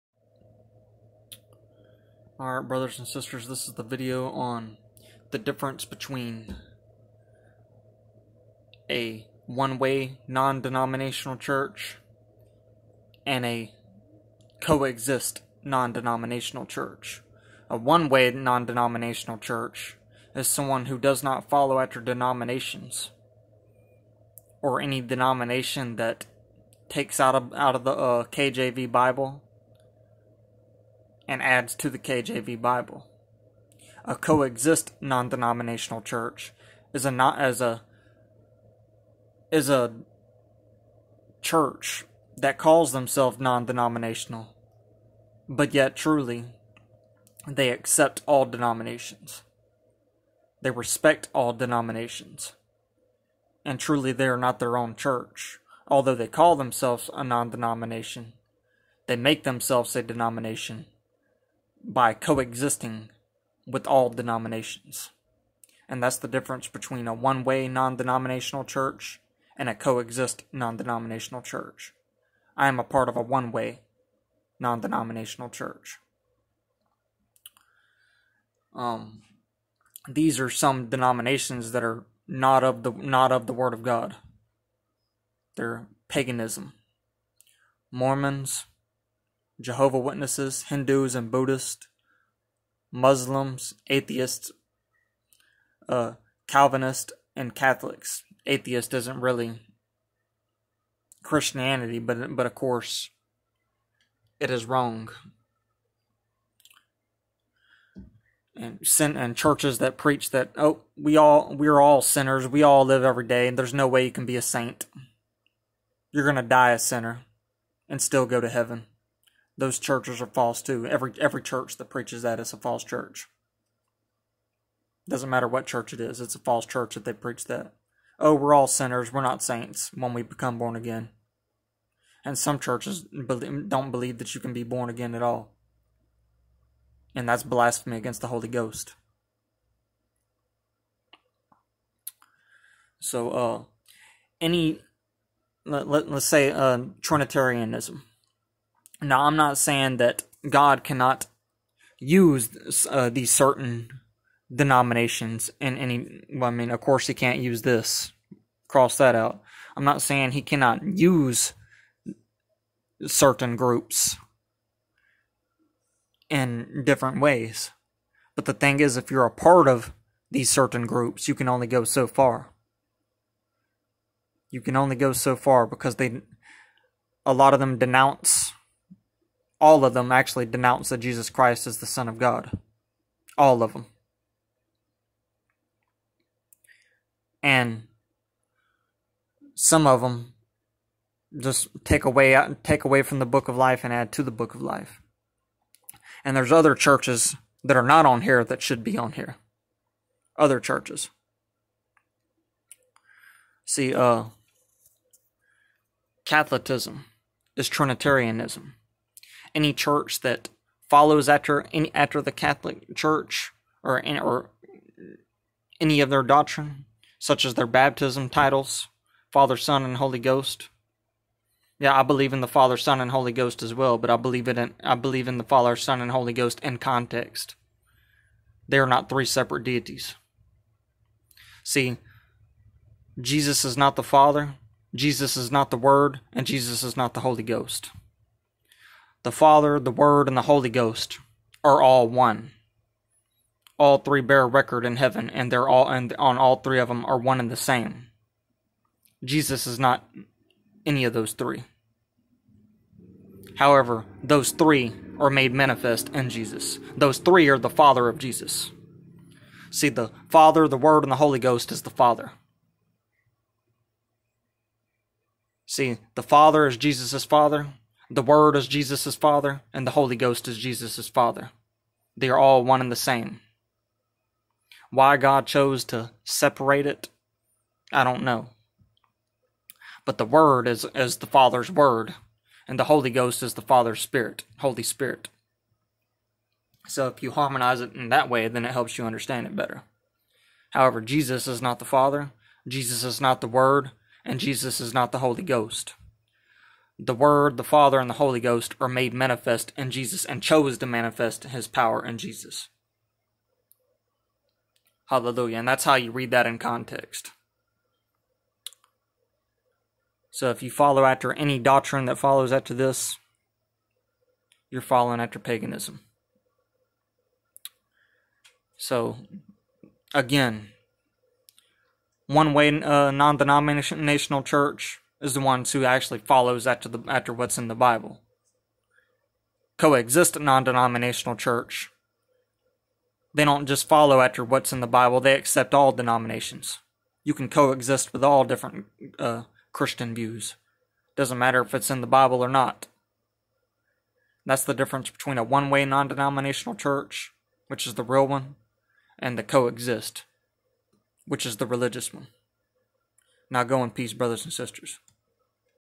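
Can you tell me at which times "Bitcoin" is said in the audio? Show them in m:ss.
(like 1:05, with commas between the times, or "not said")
not said.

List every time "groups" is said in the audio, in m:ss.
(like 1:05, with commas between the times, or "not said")
2:43, 2:50.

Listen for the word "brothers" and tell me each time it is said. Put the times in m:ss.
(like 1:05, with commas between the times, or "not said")
0:02, 5:54.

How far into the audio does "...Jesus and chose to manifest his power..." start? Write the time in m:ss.
4:59.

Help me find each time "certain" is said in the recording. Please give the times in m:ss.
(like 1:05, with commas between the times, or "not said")
2:33, 2:43, 2:50.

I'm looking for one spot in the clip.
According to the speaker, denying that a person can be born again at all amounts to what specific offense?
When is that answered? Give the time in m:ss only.
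2:17.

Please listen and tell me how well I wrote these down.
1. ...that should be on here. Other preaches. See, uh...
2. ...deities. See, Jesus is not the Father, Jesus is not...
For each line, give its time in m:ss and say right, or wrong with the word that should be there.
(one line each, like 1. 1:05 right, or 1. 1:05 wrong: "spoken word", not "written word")
1. 3:18 wrong: "churches", not "preaches"
2. 3:49 right.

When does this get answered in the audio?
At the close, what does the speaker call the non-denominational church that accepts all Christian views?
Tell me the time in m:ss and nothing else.
5:51.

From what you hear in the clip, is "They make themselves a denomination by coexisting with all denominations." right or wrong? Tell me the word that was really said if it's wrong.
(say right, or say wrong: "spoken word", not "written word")
right.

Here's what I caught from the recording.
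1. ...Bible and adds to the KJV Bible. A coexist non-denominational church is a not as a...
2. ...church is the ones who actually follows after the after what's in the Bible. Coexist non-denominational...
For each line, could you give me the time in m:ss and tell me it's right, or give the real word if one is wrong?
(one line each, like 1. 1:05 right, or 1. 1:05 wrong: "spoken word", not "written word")
1. 0:28 right
2. 5:24 right.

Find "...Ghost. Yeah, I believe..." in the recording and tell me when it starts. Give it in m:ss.
3:40.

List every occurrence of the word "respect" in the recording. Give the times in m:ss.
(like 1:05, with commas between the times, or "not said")
0:50.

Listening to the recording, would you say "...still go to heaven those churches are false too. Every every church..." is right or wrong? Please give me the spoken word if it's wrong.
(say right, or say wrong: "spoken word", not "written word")
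right.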